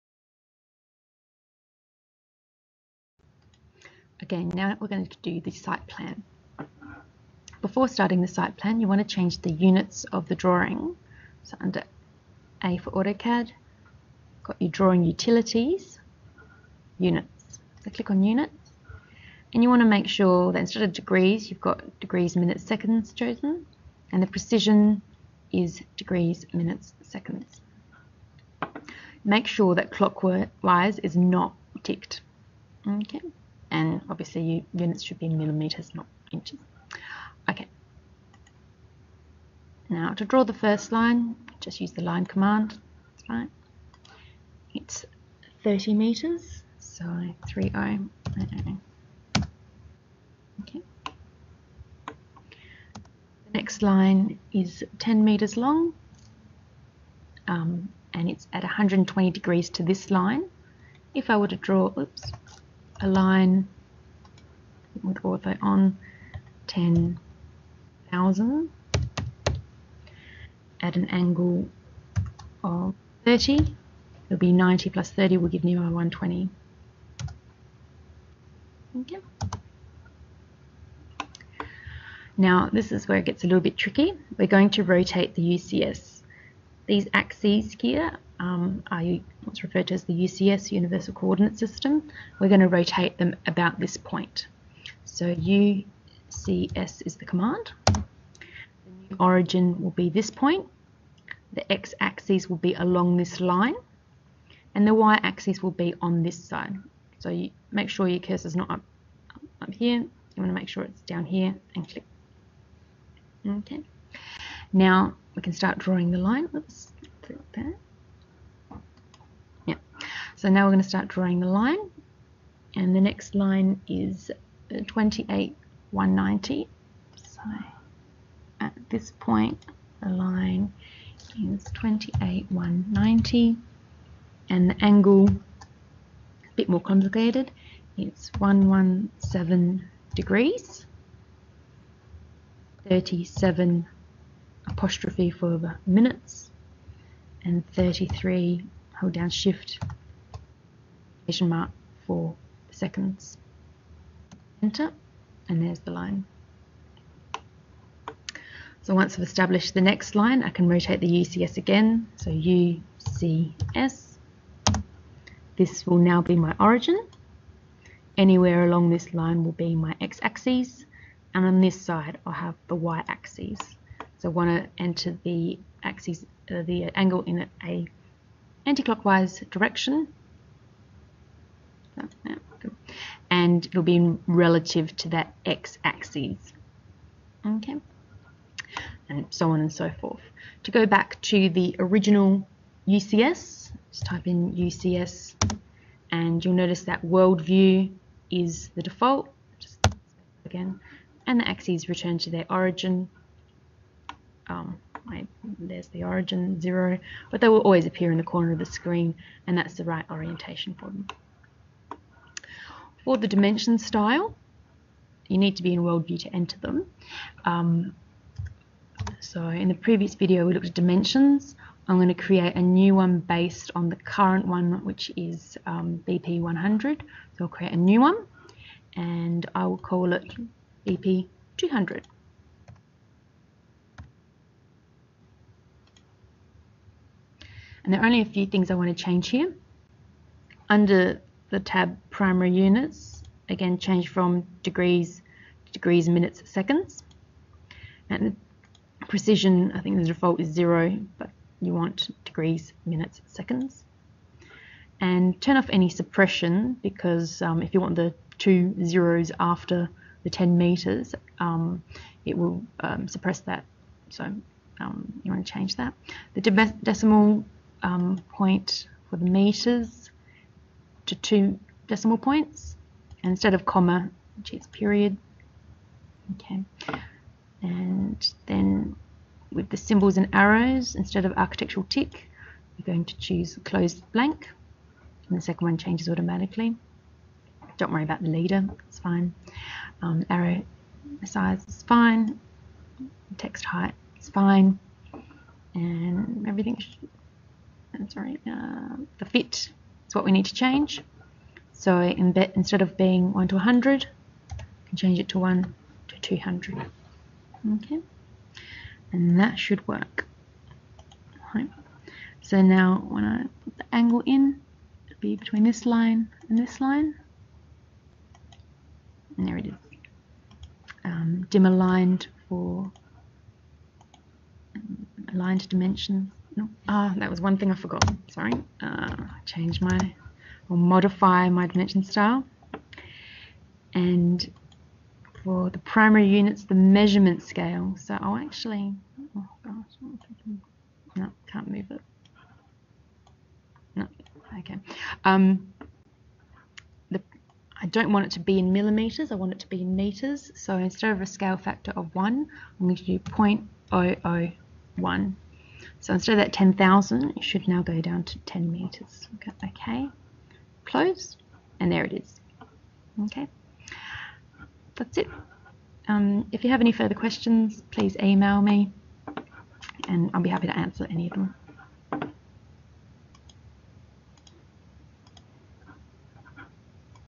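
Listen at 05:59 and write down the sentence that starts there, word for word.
Okay, close, and there it is.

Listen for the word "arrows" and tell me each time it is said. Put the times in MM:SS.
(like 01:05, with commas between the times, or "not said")
04:40, 04:50.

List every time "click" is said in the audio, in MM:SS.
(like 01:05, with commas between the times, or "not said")
00:17, 01:51.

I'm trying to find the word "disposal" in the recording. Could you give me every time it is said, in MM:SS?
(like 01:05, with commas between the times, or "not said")
not said.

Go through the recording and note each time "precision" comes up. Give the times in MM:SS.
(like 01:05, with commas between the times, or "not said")
00:24, 04:09.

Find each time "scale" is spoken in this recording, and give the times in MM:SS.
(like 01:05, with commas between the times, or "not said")
05:37, 05:51.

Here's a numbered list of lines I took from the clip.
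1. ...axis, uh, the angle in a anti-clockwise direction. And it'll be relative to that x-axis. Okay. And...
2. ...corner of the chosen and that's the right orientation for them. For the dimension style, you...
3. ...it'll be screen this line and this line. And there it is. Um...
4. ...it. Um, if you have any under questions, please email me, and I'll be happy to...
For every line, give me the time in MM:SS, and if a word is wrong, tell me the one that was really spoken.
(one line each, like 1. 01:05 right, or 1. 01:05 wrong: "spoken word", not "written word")
1. 02:55 right
2. 03:28 wrong: "screen", not "chosen"
3. 05:15 wrong: "between", not "screen"
4. 06:05 wrong: "further", not "under".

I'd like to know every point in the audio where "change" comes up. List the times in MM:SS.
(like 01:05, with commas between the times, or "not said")
00:09, 03:59, 04:03, 04:25, 04:45, 05:00, 05:04, 05:29.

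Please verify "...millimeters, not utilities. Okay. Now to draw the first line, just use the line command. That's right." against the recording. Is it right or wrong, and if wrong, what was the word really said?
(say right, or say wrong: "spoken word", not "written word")
wrong: "inches", not "utilities".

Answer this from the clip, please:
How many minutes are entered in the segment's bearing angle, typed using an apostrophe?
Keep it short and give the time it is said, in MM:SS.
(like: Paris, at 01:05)
37, at 02:22.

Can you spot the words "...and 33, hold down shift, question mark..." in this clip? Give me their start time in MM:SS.
02:27.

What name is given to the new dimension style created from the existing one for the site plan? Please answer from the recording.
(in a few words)
BP200.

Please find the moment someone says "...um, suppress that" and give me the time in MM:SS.
04:22.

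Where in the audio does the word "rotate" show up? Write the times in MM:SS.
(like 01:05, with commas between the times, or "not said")
01:24, 01:32, 02:40.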